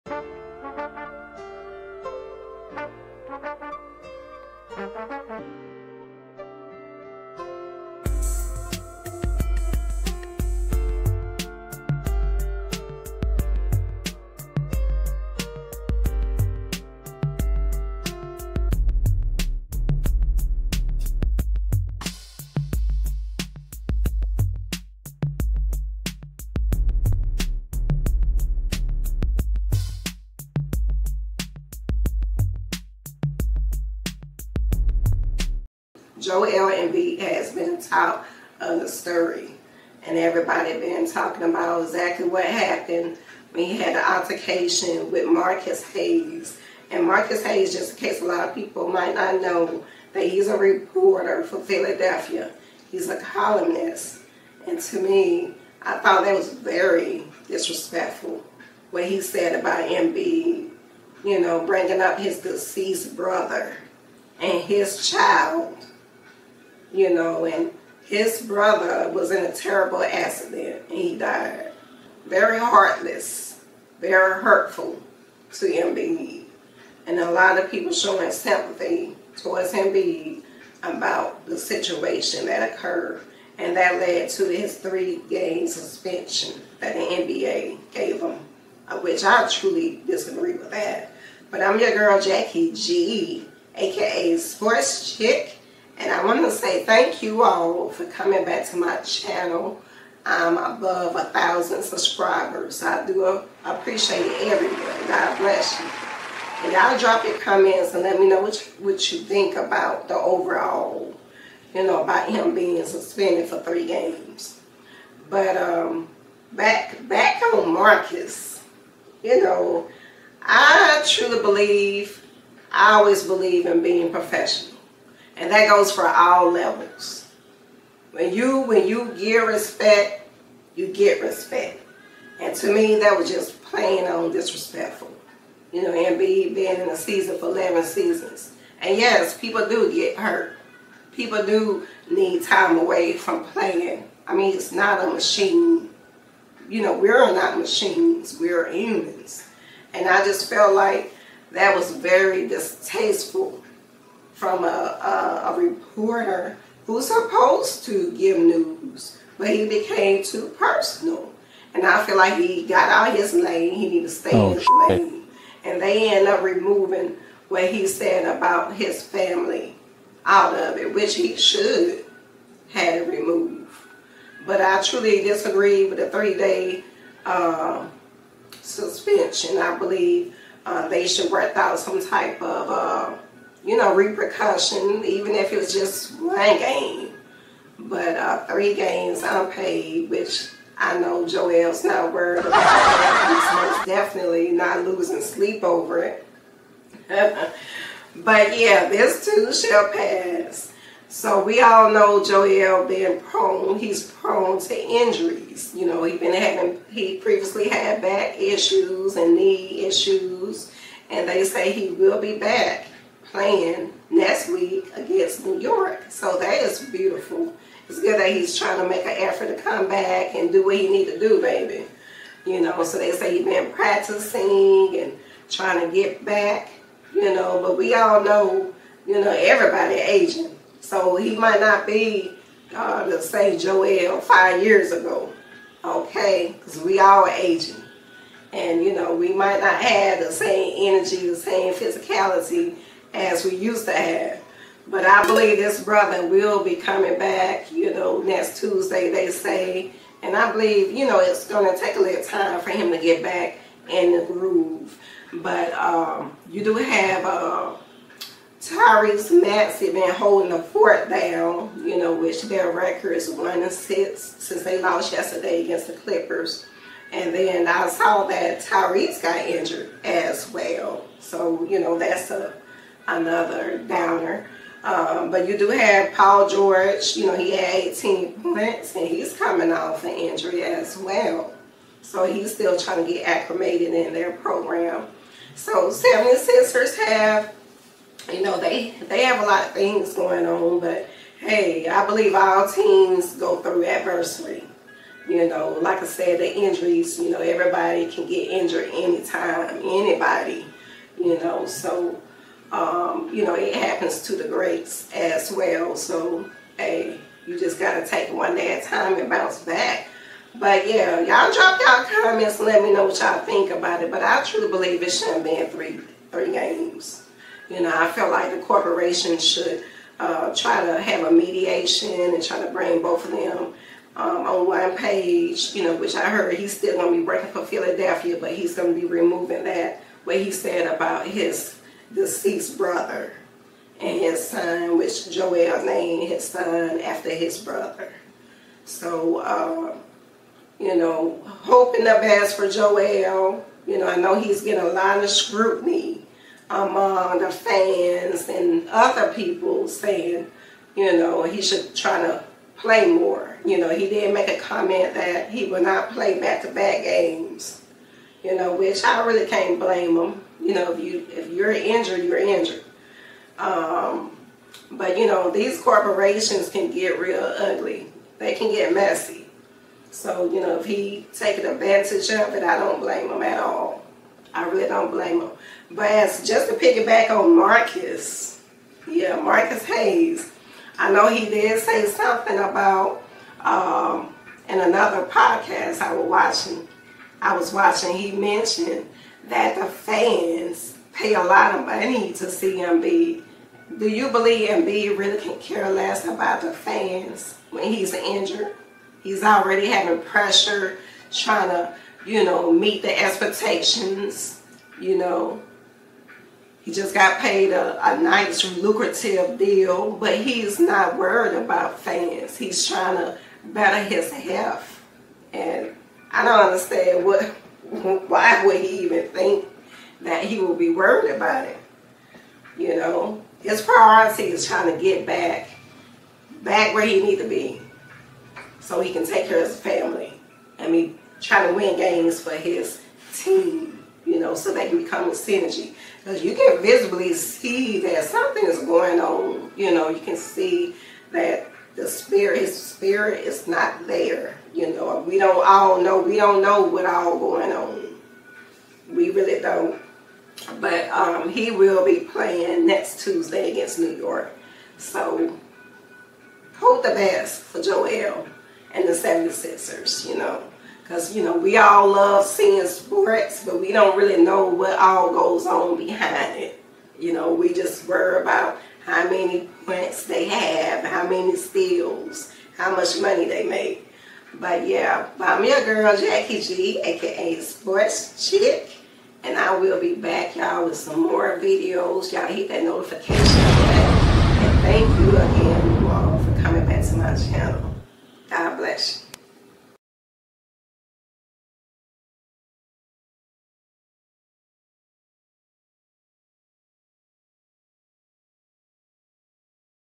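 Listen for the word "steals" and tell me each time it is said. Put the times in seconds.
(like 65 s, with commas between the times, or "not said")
471 s.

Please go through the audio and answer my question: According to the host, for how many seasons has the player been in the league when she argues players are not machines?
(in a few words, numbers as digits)
11.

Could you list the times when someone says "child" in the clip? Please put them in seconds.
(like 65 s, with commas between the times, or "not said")
65 s.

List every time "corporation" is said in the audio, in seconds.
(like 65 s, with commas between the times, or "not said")
318 s, 365 s.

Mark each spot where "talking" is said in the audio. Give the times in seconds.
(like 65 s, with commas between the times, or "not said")
41 s.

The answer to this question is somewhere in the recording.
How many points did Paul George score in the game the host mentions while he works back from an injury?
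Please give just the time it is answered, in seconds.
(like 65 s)
277 s.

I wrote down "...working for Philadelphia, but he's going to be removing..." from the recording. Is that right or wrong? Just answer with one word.
right.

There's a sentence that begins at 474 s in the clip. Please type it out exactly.
But yeah, I'm your girl Jackie G, aka Sports Chick, and I will be back, y'all, with some more videos.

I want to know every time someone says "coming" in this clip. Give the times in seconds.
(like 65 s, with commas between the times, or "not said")
98 s, 246 s, 279 s, 486 s.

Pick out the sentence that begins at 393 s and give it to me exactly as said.
Do you believe Embiid really can care less about the fans when he's injured?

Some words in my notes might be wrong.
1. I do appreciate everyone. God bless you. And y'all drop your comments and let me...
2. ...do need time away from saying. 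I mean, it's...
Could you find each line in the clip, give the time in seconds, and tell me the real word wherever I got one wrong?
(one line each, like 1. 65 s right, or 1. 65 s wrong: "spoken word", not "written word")
1. 102 s right
2. 141 s wrong: "playing", not "saying".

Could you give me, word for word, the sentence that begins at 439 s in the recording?
You know, you can see that the spirit, his spirit is not there.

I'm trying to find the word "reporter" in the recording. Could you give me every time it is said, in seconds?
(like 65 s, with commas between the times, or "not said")
50 s, 155 s.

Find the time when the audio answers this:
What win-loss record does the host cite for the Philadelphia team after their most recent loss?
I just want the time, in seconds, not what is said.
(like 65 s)
263 s.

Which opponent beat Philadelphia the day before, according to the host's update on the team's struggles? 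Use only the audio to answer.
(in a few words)
Clippers.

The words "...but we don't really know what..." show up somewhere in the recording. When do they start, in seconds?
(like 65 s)
463 s.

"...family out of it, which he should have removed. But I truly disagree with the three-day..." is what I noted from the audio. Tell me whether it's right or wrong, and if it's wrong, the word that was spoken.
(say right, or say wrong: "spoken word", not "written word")
right.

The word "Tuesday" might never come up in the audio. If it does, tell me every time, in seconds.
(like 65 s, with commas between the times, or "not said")
248 s, 453 s.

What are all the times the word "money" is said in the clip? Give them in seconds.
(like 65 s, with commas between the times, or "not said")
391 s, 473 s.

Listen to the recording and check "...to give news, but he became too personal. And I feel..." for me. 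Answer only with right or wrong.
right.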